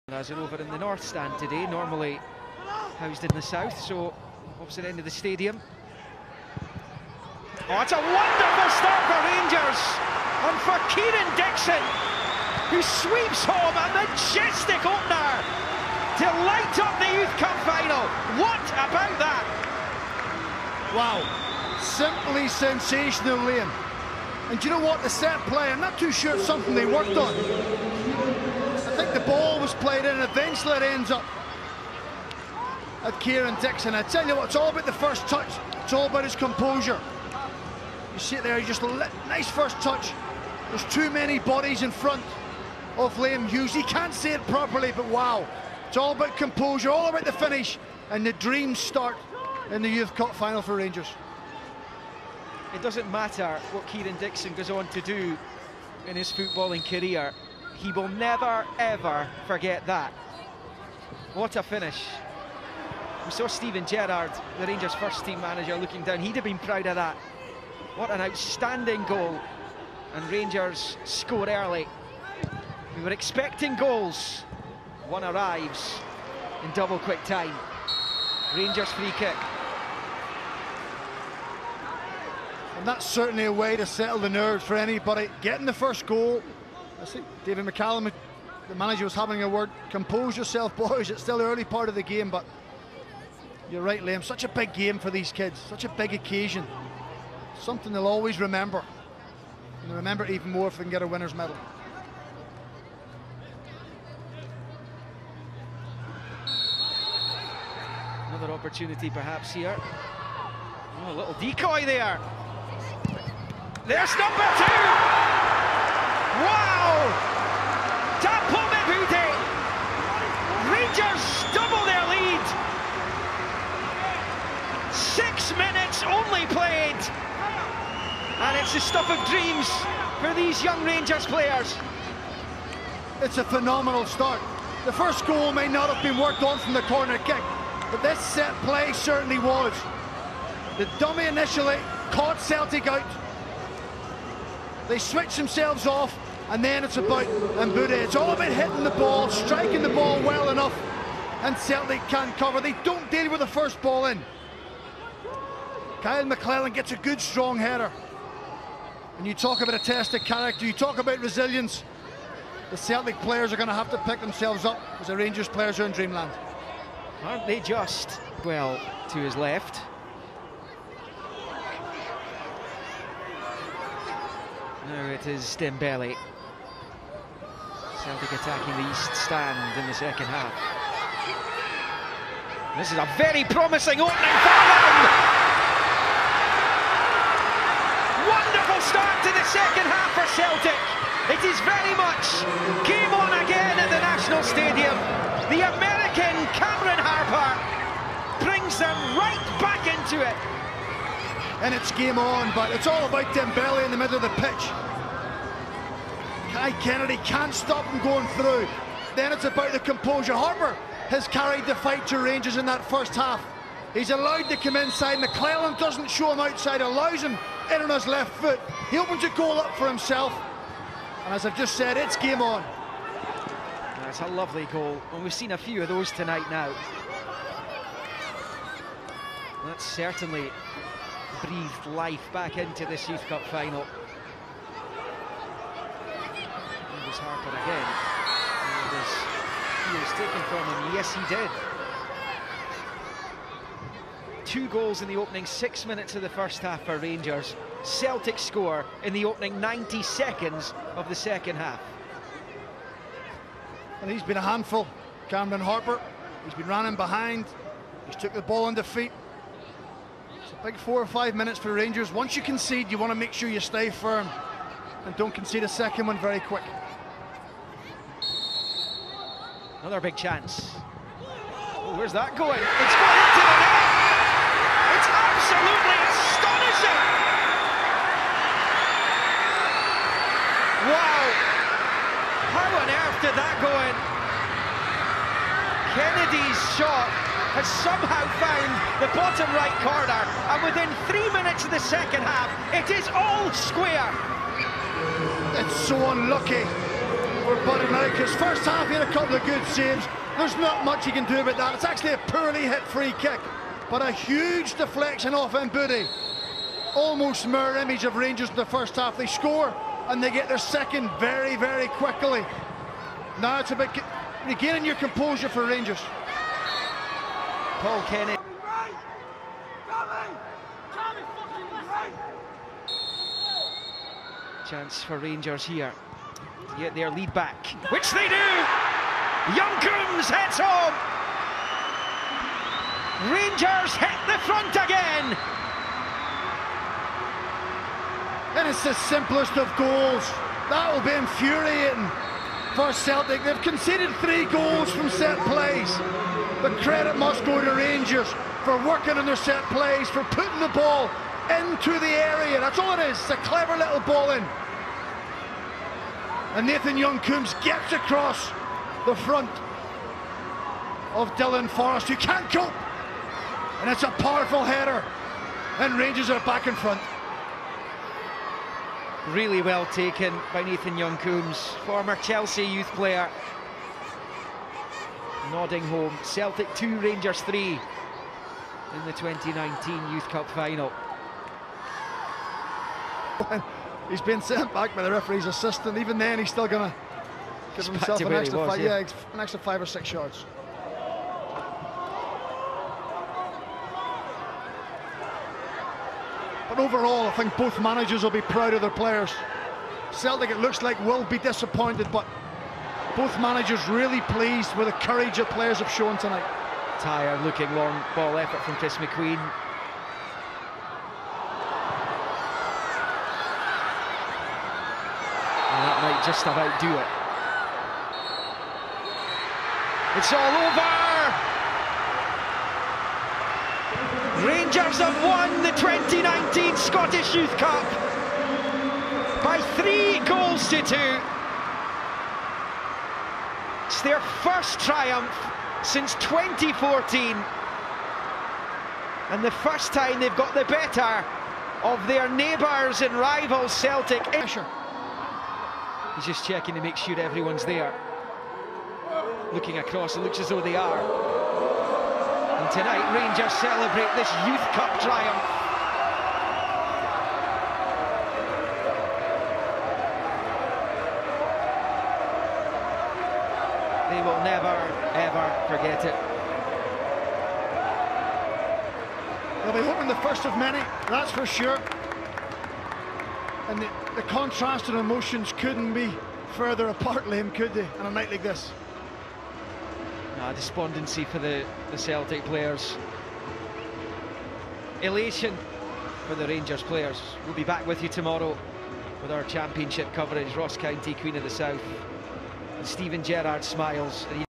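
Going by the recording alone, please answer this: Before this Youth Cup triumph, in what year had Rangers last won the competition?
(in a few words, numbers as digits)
2014.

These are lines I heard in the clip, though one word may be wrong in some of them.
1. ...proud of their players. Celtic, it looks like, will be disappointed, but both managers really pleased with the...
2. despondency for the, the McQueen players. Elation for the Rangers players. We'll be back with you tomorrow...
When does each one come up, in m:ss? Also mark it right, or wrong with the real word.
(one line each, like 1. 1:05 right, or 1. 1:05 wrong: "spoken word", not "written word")
1. 6:38 right
2. 8:00 wrong: "Celtic", not "McQueen".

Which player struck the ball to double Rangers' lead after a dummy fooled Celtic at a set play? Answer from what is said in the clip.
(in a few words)
Dapo Mebude.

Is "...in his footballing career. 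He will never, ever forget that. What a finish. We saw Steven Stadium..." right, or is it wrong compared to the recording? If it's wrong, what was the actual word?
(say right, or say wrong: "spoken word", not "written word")
wrong: "Gerrard", not "Stadium".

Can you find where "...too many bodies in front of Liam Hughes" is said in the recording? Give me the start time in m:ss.
0:40.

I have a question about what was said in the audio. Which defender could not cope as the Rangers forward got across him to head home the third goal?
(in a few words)
Dylan Forrest.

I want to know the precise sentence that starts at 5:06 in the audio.
Almost mirror image of Rangers in the first half.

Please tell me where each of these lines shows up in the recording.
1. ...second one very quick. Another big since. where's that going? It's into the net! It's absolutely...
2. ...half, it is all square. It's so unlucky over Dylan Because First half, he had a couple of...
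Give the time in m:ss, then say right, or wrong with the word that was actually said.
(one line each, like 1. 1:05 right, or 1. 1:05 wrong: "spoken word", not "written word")
1. 4:25 wrong: "chance", not "since"
2. 4:52 wrong: "Buddy", not "Dylan".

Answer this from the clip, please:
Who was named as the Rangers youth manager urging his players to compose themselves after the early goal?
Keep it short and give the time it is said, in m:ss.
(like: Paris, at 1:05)
David McCallum, at 1:27.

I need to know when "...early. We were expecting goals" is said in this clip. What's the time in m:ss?
1:11.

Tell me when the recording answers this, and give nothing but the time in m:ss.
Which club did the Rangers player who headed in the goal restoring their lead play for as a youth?
6:12.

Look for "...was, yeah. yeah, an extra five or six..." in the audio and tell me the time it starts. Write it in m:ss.
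6:28.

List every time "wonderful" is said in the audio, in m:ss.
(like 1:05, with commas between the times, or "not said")
0:07, 3:08.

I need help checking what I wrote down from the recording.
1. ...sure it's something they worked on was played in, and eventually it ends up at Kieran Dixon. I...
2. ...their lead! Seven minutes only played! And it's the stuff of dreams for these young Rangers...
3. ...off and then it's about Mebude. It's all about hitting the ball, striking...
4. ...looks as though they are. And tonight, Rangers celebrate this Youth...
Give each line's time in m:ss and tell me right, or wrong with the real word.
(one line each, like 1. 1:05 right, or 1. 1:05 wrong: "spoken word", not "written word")
1. 0:26 right
2. 2:01 wrong: "Six", not "Seven"
3. 2:25 right
4. 7:30 right.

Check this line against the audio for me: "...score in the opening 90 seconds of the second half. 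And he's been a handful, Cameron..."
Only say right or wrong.
right.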